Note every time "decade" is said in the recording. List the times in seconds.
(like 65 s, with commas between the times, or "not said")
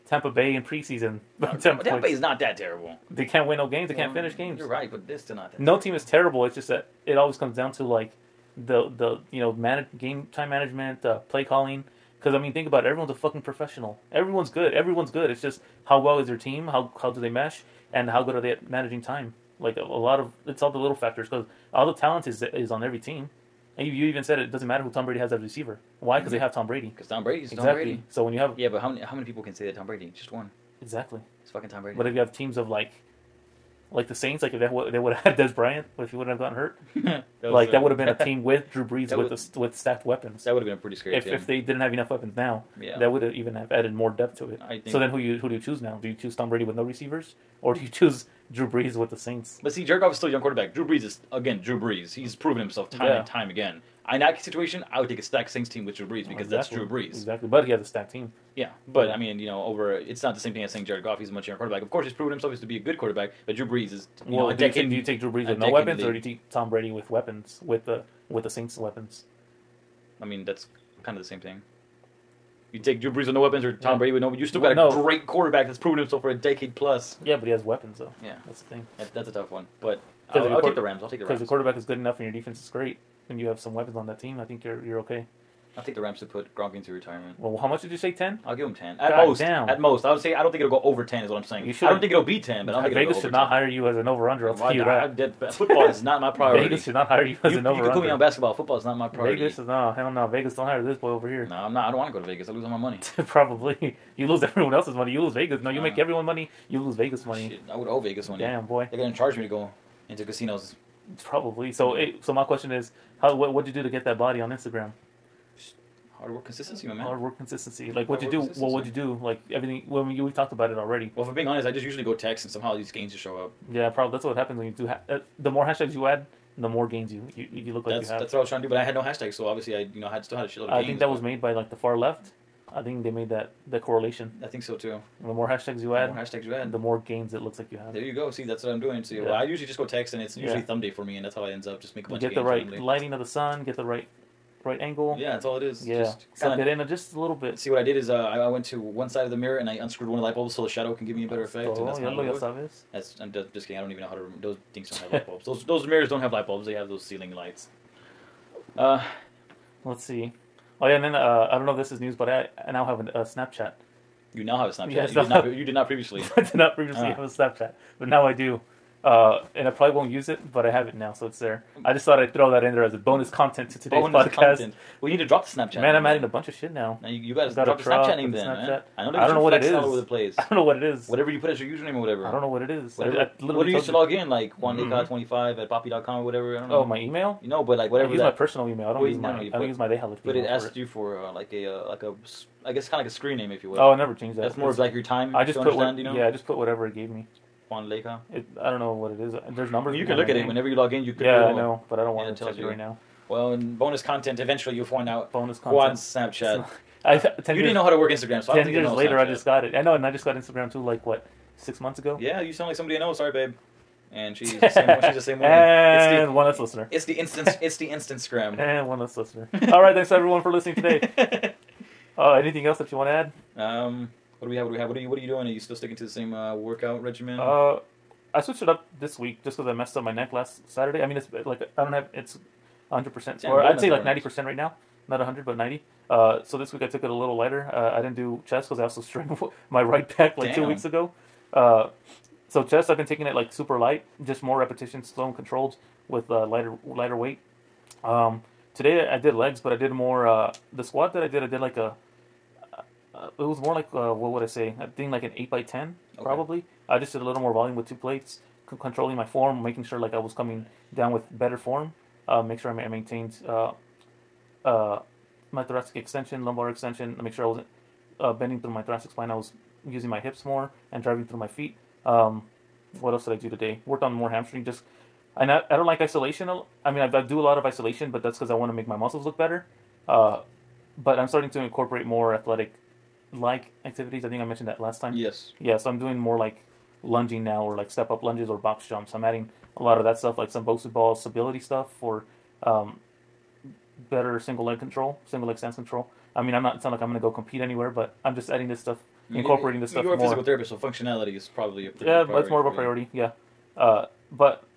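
64 s, 76 s.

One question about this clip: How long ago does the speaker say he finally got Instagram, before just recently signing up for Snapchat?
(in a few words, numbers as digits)
6 months.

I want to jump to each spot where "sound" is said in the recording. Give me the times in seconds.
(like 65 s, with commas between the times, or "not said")
212 s, 296 s.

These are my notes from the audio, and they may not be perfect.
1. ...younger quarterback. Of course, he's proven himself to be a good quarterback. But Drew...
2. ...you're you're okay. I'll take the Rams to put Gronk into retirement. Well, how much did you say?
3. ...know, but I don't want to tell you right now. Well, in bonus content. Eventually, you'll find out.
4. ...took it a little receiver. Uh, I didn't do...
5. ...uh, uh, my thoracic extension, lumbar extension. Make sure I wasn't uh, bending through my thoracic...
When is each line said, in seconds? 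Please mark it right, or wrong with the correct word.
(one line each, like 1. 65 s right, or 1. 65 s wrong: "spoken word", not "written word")
1. 61 s right
2. 84 s right
3. 201 s right
4. 236 s wrong: "lighter", not "receiver"
5. 263 s right.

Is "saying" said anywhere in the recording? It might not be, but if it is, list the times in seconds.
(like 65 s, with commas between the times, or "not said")
60 s, 91 s.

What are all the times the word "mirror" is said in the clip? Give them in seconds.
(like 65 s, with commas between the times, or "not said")
149 s, 155 s.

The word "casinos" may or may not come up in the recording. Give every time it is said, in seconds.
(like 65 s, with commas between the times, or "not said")
110 s.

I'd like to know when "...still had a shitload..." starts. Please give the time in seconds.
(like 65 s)
130 s.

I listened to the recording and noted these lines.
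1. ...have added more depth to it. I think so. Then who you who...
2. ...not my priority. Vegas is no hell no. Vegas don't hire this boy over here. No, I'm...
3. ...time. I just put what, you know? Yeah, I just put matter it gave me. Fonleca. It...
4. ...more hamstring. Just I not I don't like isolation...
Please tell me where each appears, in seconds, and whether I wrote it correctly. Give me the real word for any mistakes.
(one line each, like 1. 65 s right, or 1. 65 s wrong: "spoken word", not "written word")
1. 43 s right
2. 98 s right
3. 195 s wrong: "whatever", not "matter"
4. 274 s right.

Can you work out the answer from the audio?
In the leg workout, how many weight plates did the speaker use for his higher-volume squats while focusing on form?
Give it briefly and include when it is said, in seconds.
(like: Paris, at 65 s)
2, at 257 s.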